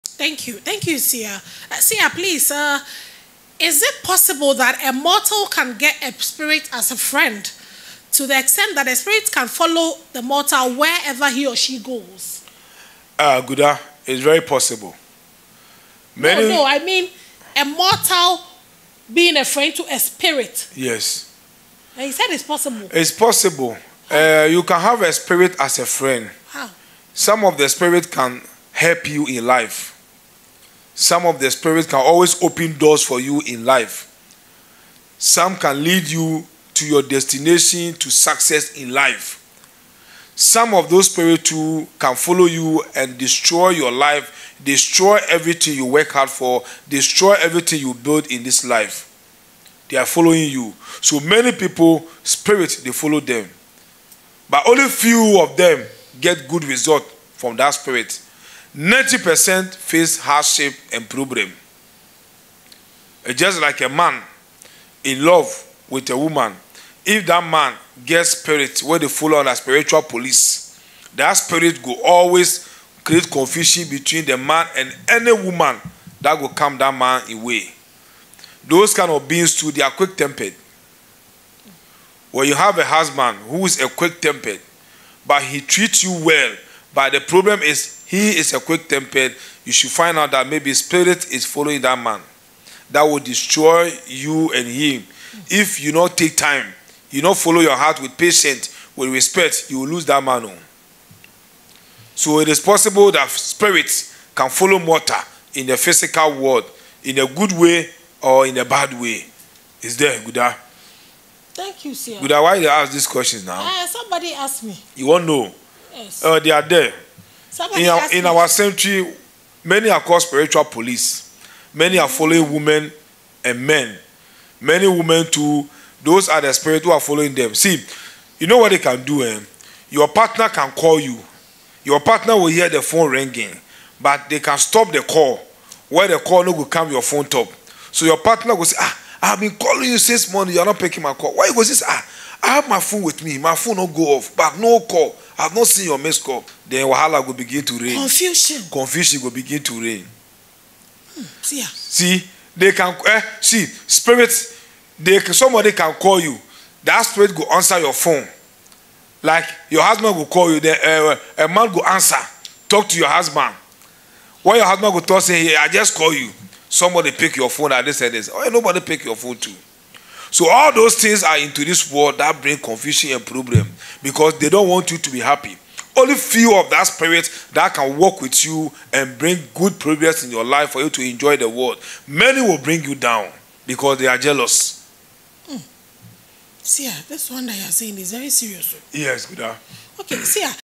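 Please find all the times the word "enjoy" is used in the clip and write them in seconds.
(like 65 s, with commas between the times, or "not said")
181 s.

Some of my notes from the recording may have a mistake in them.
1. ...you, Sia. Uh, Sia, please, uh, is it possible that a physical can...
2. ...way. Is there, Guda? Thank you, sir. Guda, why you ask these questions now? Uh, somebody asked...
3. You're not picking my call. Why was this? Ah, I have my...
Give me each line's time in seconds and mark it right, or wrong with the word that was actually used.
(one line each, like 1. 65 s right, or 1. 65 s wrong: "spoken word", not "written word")
1. 0 s wrong: "mortal", not "physical"
2. 108 s right
3. 140 s right.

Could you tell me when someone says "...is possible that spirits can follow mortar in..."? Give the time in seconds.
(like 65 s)
102 s.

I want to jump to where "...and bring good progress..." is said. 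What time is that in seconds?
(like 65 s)
178 s.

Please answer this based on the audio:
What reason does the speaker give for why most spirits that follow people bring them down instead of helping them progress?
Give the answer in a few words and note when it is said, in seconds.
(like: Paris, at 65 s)
they are jealous, at 183 s.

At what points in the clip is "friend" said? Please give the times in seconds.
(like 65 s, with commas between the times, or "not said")
6 s, 19 s, 25 s.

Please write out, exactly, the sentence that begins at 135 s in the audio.
Where the call no will come your phone top.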